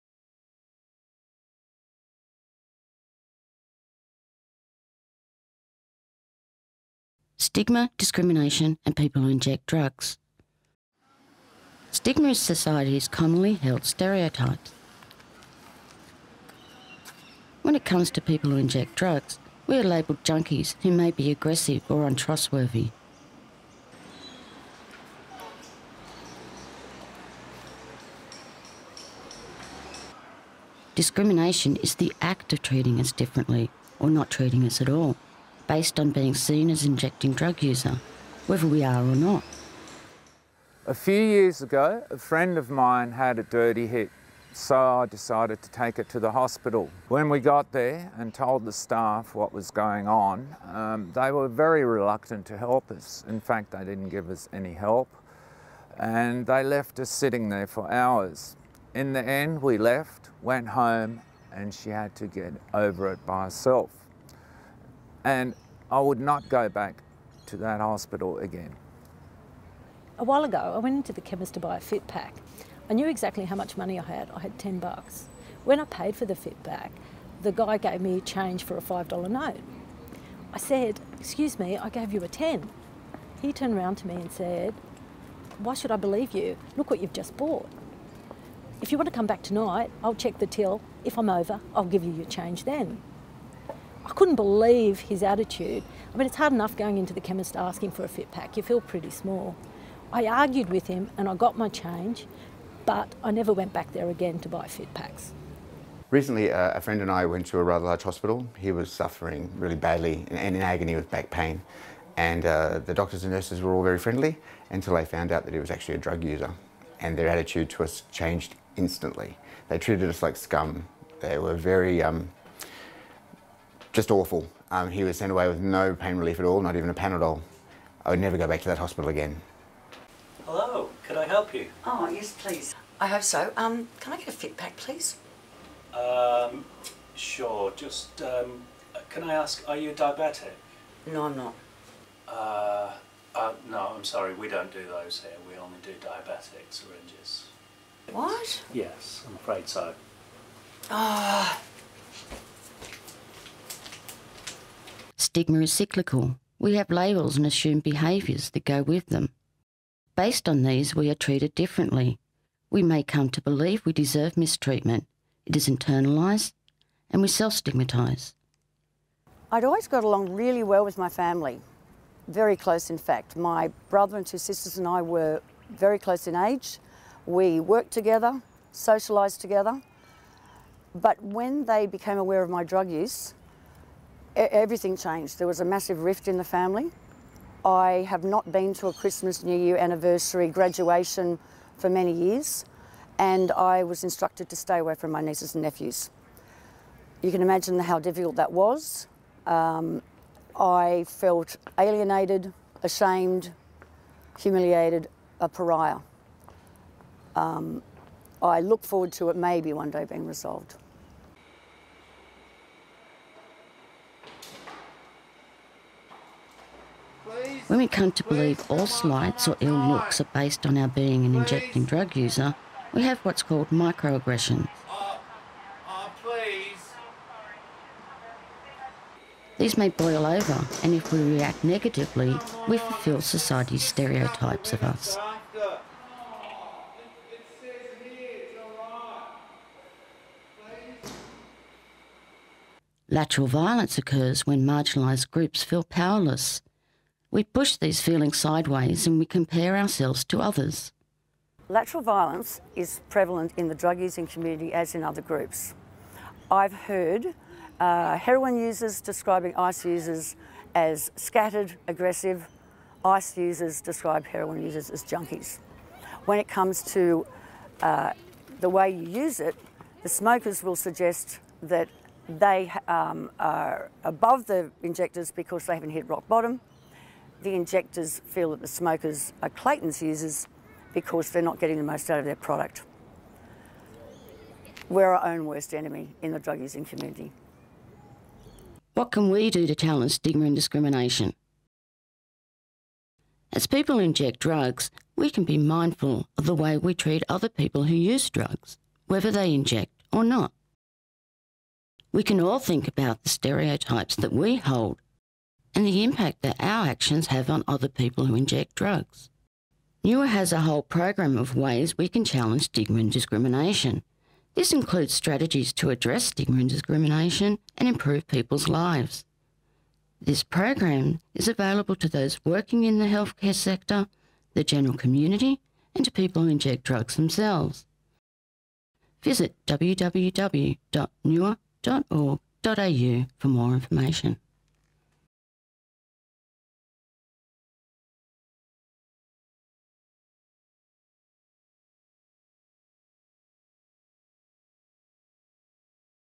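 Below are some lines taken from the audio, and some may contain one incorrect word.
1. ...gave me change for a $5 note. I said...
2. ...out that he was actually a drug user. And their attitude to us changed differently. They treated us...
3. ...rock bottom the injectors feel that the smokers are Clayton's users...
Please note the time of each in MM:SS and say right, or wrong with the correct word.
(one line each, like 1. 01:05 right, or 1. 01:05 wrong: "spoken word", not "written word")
1. 01:17 right
2. 01:55 wrong: "instantly", not "differently"
3. 04:36 right.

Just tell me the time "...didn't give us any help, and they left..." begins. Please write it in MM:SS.
00:53.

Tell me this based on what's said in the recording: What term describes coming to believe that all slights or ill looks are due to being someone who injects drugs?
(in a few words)
microaggression.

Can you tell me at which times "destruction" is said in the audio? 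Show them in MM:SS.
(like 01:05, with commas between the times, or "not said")
not said.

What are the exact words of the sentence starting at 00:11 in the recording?
Stigma is society's commonly held stereotypes.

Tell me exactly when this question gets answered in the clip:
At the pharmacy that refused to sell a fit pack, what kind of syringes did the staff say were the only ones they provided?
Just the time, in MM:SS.
02:26.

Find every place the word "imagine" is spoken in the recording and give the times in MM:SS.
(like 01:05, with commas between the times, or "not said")
03:17.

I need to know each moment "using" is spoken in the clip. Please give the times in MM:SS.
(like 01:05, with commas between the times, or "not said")
04:13, 04:46.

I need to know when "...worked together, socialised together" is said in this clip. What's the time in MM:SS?
02:57.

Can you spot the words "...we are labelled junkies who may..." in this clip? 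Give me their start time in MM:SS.
00:19.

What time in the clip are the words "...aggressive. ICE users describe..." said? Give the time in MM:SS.
04:21.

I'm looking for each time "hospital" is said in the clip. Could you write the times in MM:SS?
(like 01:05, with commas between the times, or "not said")
00:46, 01:07, 01:48, 02:08.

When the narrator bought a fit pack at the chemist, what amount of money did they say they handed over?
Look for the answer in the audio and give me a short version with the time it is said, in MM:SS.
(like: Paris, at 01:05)
$10, at 01:14.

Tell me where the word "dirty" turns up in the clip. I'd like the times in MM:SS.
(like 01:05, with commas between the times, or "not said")
00:43.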